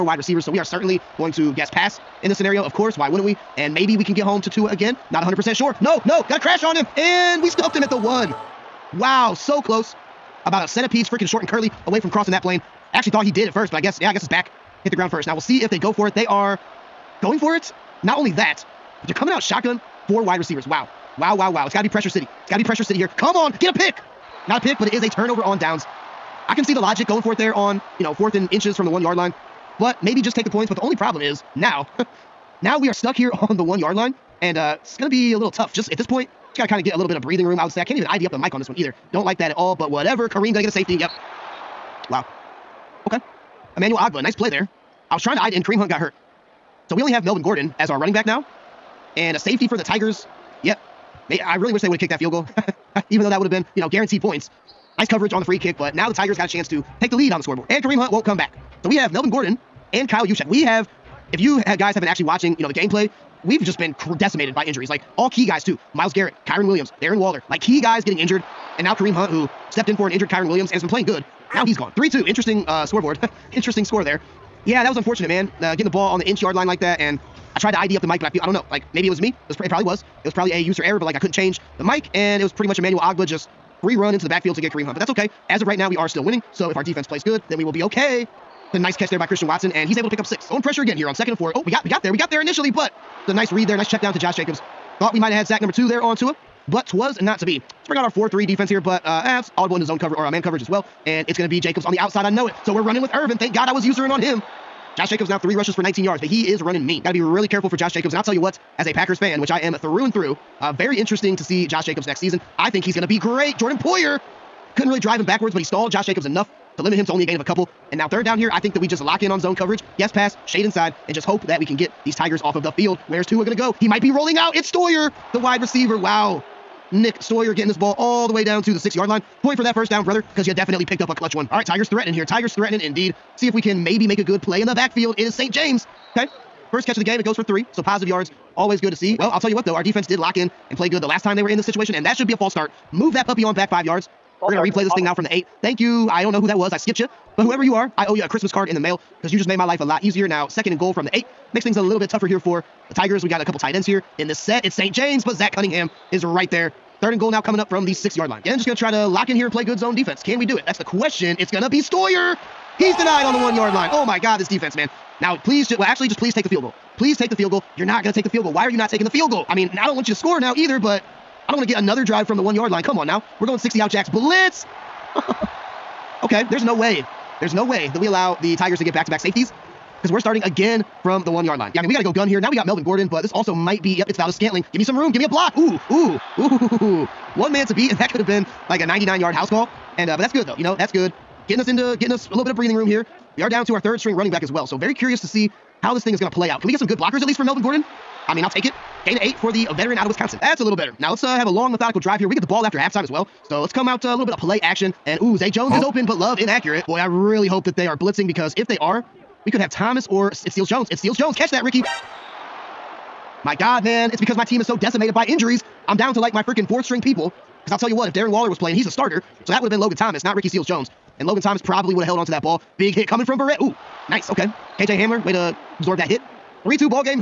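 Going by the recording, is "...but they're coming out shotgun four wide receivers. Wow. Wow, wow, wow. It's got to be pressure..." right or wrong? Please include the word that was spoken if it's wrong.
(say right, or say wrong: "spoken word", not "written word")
right.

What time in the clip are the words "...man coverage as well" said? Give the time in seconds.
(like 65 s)
100 s.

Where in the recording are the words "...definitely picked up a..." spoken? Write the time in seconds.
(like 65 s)
130 s.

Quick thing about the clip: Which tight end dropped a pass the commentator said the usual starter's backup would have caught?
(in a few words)
Ricky Seals Jones.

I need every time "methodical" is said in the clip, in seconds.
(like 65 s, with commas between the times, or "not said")
201 s.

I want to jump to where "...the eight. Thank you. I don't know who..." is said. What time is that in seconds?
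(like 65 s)
145 s.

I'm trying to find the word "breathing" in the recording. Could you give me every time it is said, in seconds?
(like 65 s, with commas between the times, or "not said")
37 s, 192 s.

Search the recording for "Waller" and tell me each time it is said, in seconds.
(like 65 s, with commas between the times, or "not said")
67 s, 218 s.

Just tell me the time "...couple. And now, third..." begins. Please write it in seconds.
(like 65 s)
117 s.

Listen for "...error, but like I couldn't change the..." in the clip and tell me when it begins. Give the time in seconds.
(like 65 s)
80 s.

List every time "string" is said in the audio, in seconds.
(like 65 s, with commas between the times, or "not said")
193 s, 216 s.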